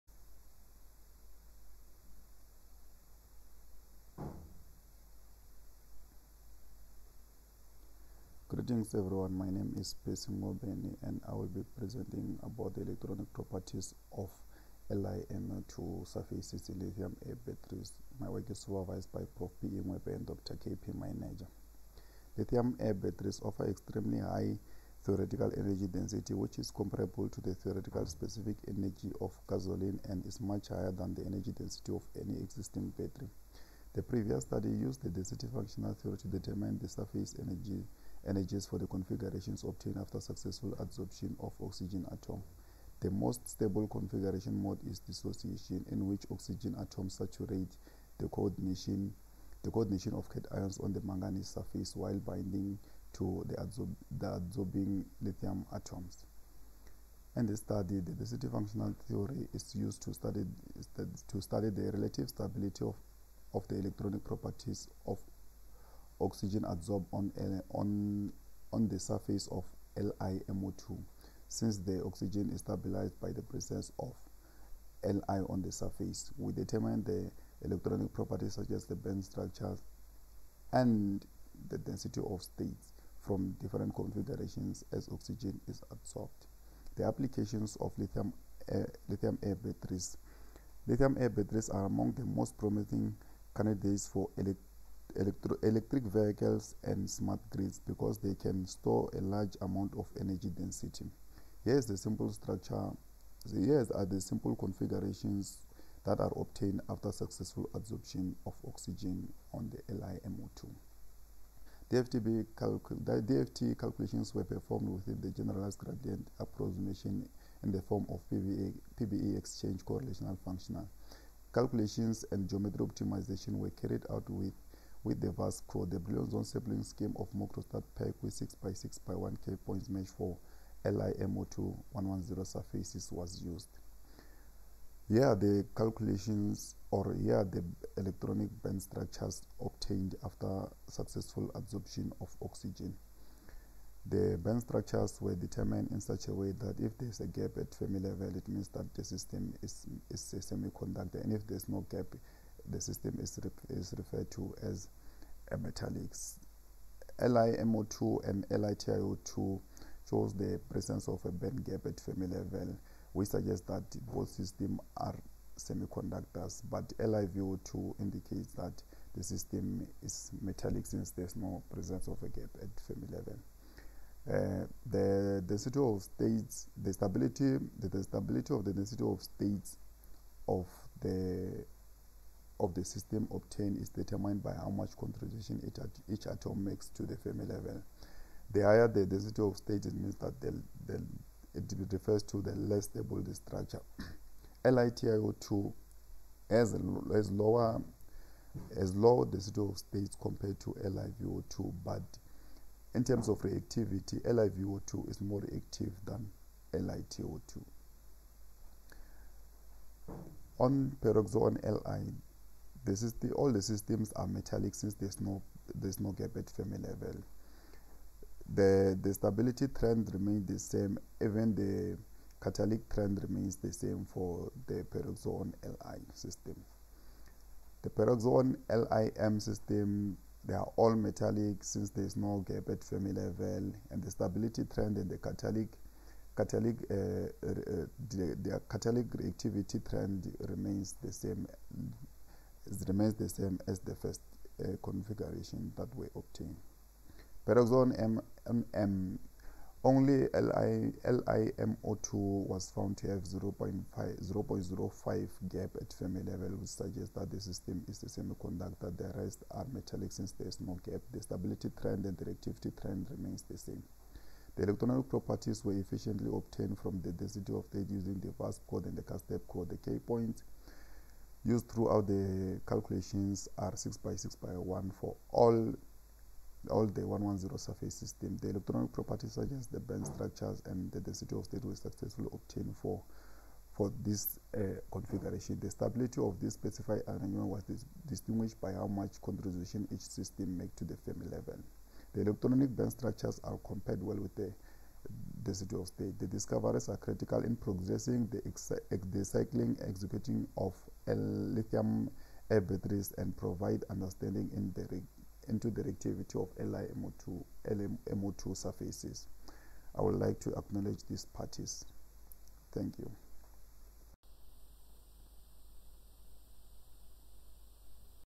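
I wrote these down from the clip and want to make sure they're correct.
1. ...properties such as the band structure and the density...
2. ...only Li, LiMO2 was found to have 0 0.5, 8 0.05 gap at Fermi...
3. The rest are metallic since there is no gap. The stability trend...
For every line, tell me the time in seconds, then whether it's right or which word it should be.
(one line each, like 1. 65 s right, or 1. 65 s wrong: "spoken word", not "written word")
1. 78 s right
2. 249 s wrong: "0", not "8"
3. 258 s right.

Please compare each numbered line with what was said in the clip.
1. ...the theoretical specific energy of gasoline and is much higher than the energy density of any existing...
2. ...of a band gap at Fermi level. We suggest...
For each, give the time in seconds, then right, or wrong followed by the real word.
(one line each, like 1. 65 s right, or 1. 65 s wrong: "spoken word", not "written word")
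1. 27 s right
2. 161 s right.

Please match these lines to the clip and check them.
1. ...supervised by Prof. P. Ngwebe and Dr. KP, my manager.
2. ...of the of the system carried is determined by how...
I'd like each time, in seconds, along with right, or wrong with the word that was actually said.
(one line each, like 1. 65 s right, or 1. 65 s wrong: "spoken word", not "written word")
1. 18 s right
2. 180 s wrong: "obtained", not "carried".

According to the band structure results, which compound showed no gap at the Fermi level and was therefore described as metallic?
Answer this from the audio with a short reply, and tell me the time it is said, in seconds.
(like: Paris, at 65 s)
LiVO2, at 166 s.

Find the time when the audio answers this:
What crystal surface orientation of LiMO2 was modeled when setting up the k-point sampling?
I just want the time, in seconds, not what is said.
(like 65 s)
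130 s.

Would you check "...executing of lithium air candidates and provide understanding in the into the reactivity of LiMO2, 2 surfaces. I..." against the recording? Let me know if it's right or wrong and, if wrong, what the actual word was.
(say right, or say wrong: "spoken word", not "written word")
wrong: "batteries", not "candidates".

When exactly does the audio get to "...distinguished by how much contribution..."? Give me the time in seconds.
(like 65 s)
288 s.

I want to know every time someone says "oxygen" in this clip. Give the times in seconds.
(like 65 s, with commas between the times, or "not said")
41 s, 46 s, 66 s, 72 s, 85 s, 108 s, 142 s.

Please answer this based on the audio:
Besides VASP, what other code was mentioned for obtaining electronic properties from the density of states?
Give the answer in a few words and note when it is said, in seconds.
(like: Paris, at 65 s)
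CASTEP, at 268 s.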